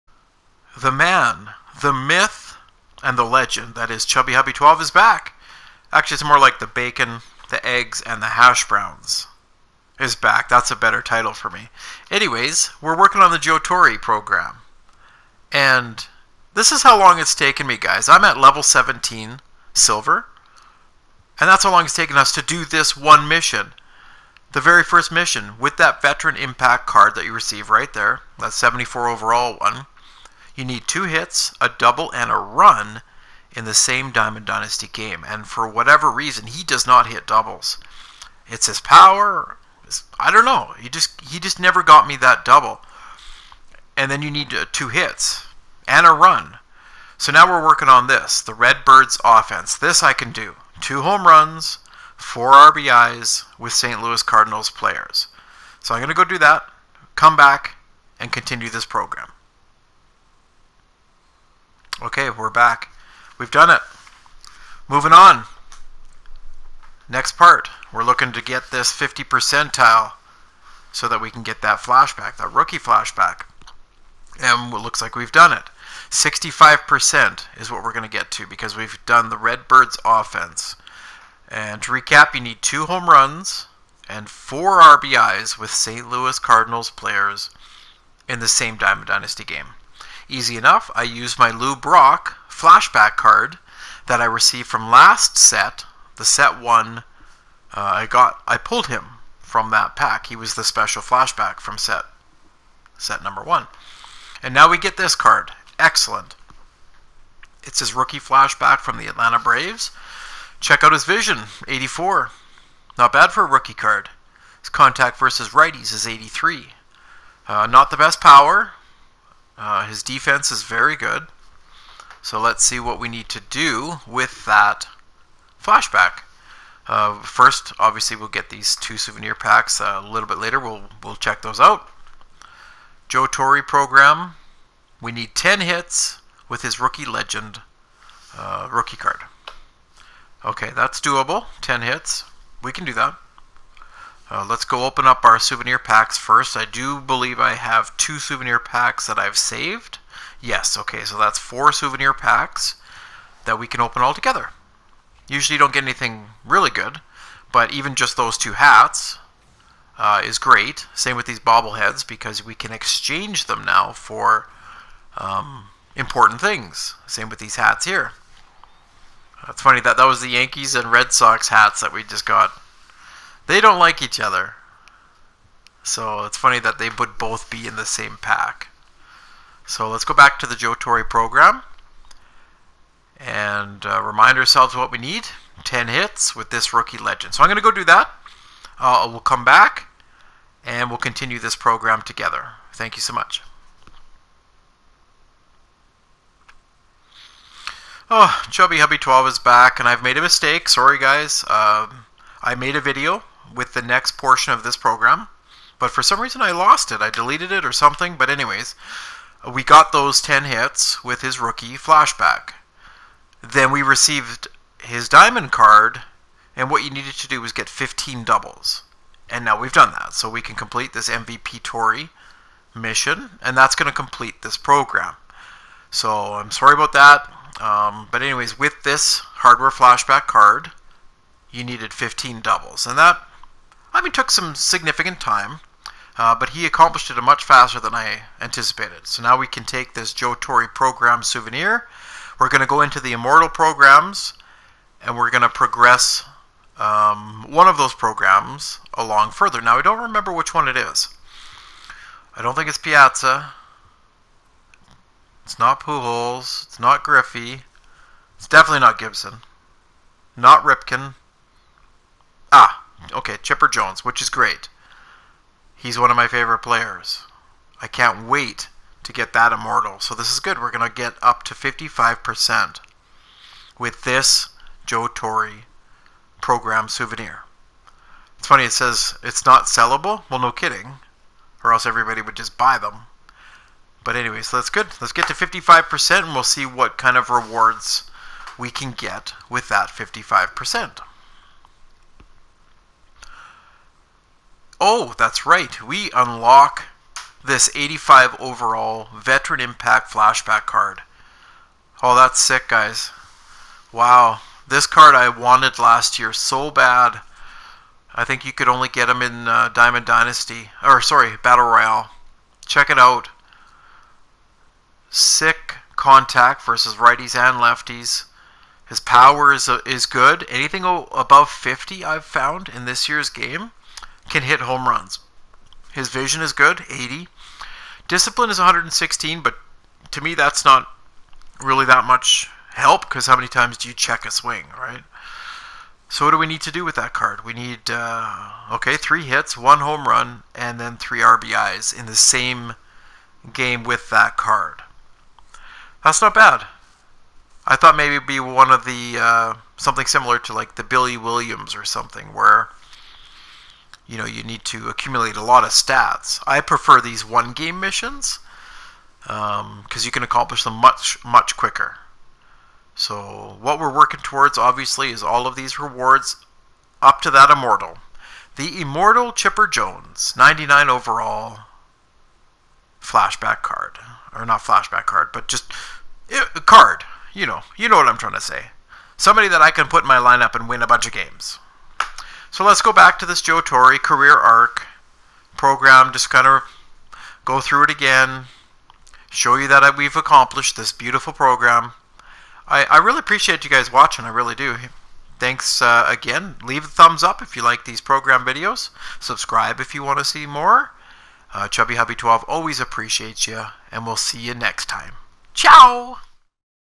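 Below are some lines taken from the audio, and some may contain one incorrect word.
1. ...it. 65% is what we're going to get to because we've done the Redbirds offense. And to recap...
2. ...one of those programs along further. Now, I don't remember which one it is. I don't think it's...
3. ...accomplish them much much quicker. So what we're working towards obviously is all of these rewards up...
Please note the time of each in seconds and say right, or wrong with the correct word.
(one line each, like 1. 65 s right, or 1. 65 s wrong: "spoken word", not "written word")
1. 75 s right
2. 247 s right
3. 360 s right.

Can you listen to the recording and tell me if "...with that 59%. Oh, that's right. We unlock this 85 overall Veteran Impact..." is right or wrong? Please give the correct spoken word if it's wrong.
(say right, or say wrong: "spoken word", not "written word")
wrong: "55", not "59".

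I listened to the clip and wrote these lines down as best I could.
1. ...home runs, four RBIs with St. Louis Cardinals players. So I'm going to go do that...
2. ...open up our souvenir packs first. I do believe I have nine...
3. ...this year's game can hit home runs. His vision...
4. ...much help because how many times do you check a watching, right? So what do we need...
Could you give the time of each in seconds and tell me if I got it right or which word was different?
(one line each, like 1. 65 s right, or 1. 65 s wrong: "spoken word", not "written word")
1. 51 s right
2. 144 s wrong: "two", not "nine"
3. 322 s right
4. 332 s wrong: "swing", not "watching".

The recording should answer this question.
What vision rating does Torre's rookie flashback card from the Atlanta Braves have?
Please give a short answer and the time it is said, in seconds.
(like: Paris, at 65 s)
84, at 111 s.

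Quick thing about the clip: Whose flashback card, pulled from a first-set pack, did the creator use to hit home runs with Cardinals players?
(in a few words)
Lou Brock.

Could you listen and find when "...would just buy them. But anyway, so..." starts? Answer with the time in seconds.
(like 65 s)
282 s.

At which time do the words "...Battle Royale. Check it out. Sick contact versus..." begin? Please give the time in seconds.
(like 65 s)
311 s.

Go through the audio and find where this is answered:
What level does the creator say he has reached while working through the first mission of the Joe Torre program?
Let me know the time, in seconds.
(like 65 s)
18 s.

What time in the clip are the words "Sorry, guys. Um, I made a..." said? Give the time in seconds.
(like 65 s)
200 s.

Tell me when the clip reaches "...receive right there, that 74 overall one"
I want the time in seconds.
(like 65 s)
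27 s.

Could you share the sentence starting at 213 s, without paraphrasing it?
Then we received his diamond card, and what you needed to do was get 15 doubles.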